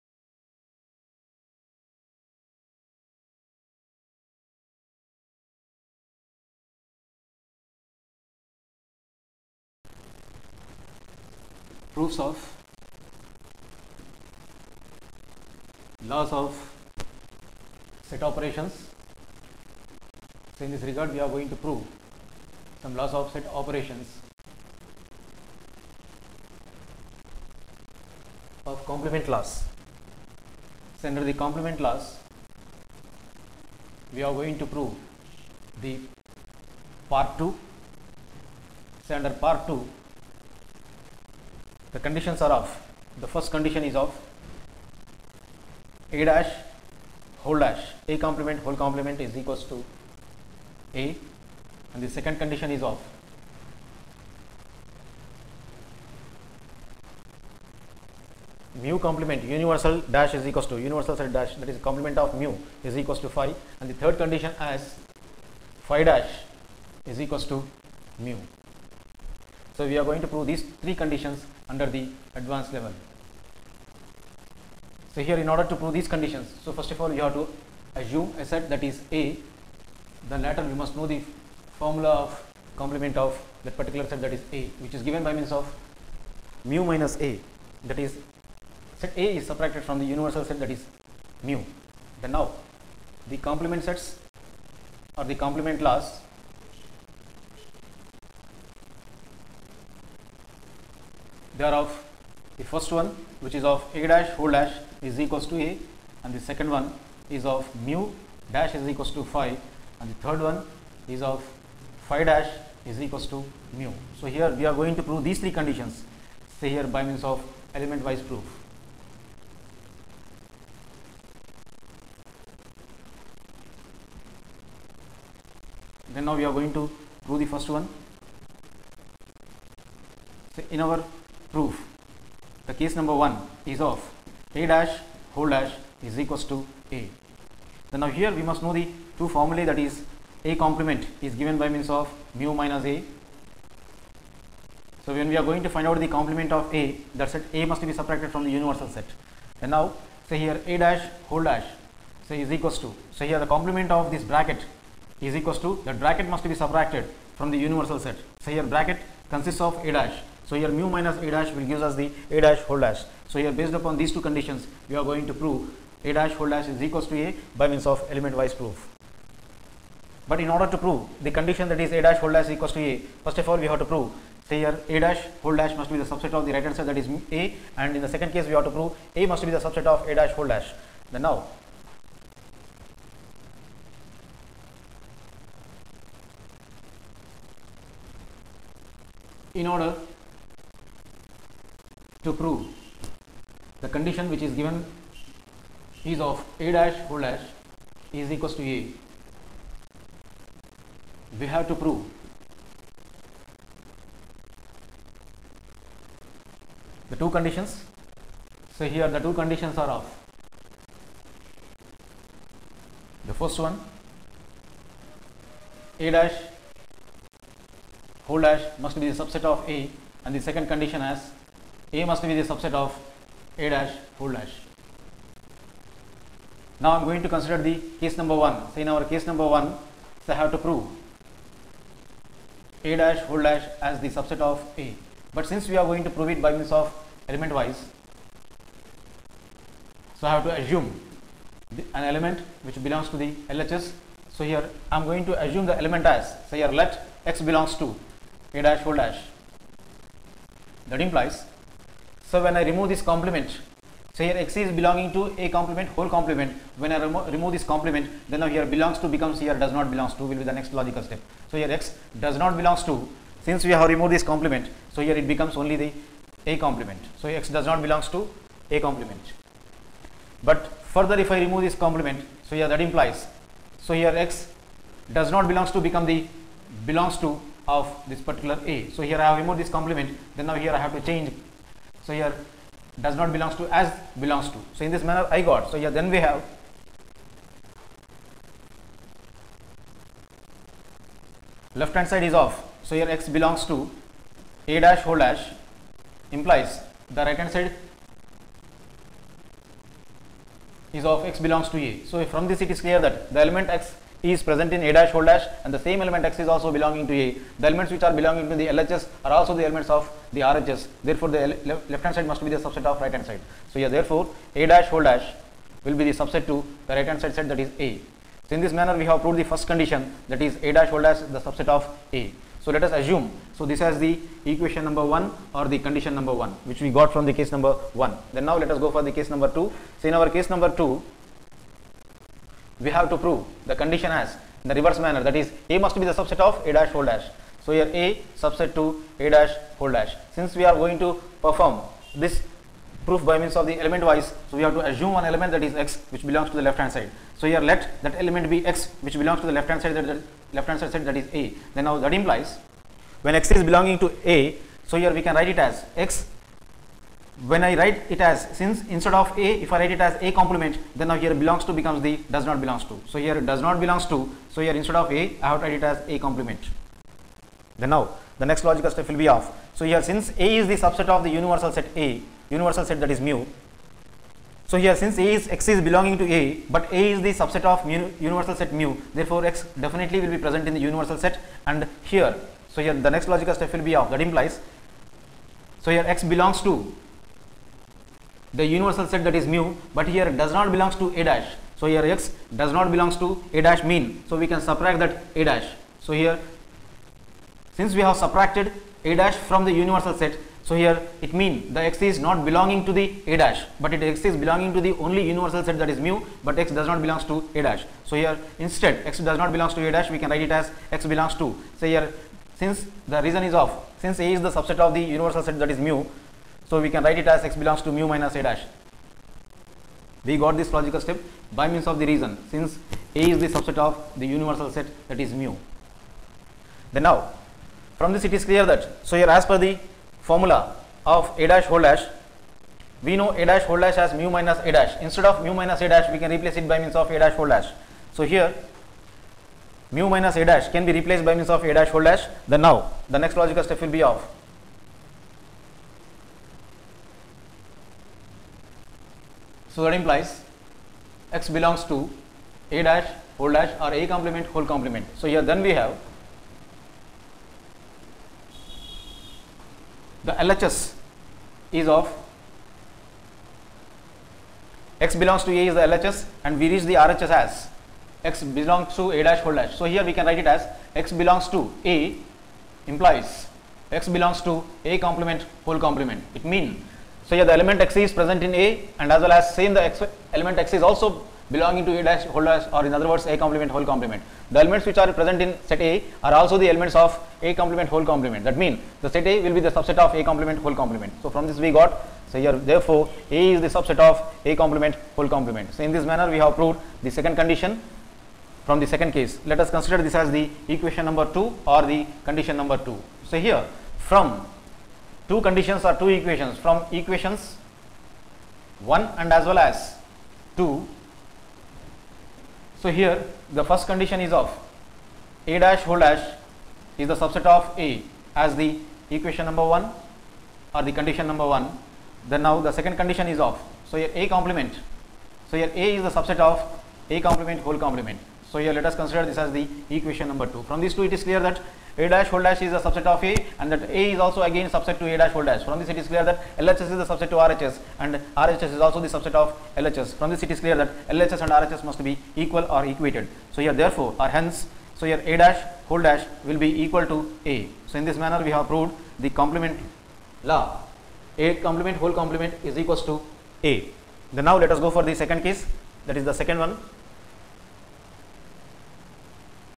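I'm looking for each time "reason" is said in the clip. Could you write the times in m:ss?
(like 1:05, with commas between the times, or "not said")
6:53, 7:02.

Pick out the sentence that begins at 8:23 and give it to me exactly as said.
So here from two conditions or two equations from equations 1 and as well as 2.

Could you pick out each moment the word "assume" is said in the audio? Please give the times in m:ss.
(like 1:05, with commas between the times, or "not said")
1:17, 4:00, 4:05, 5:22, 5:44.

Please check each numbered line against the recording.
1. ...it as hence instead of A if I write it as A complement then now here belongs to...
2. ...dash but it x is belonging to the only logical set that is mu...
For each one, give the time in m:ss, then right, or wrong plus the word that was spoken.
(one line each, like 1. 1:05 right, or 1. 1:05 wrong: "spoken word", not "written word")
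1. 5:58 wrong: "since", not "hence"
2. 6:43 wrong: "universal", not "logical".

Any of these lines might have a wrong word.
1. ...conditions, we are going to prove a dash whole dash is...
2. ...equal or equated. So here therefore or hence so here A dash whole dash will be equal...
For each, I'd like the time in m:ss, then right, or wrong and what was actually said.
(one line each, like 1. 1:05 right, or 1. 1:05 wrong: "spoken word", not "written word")
1. 2:44 right
2. 9:02 right.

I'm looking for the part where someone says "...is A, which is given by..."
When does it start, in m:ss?
1:24.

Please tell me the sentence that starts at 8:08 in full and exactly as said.
That means the set A will be the subset of A complement whole complement.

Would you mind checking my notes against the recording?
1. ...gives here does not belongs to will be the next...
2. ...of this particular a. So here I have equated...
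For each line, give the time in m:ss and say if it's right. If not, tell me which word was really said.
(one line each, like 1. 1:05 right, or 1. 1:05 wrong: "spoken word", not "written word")
1. 4:19 wrong: "becomes", not "gives"
2. 4:37 wrong: "removed", not "equated".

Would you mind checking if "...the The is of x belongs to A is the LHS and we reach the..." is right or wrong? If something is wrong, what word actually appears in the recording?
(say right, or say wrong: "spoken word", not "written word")
wrong: "LHS", not "The".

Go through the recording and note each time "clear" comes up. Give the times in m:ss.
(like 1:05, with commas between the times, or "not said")
5:02, 7:08, 8:51, 8:56, 9:00.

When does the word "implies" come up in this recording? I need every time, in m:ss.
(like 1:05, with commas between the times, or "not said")
4:11, 4:32, 4:56, 5:52, 6:24, 7:29, 7:52.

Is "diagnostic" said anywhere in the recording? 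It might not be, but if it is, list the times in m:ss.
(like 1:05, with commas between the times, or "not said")
not said.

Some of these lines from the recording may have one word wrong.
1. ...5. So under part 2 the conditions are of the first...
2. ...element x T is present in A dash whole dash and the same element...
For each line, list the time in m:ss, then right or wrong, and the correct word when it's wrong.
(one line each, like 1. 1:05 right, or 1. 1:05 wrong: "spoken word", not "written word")
1. 0:37 wrong: "2", not "5"
2. 5:03 right.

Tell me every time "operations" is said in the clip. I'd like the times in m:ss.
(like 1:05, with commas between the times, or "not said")
0:18, 0:23.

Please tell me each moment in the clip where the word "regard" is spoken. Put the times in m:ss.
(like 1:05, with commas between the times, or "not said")
0:20.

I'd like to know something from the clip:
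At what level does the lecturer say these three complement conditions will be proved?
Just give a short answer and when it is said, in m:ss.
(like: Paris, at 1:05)
Advanced level, at 1:12.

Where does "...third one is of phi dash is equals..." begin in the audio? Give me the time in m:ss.
1:50.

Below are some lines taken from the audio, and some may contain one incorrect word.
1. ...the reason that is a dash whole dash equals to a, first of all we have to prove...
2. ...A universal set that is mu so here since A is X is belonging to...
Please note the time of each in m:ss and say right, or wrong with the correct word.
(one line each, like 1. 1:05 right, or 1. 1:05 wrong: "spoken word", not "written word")
1. 2:51 wrong: "condition", not "reason"
2. 6:11 right.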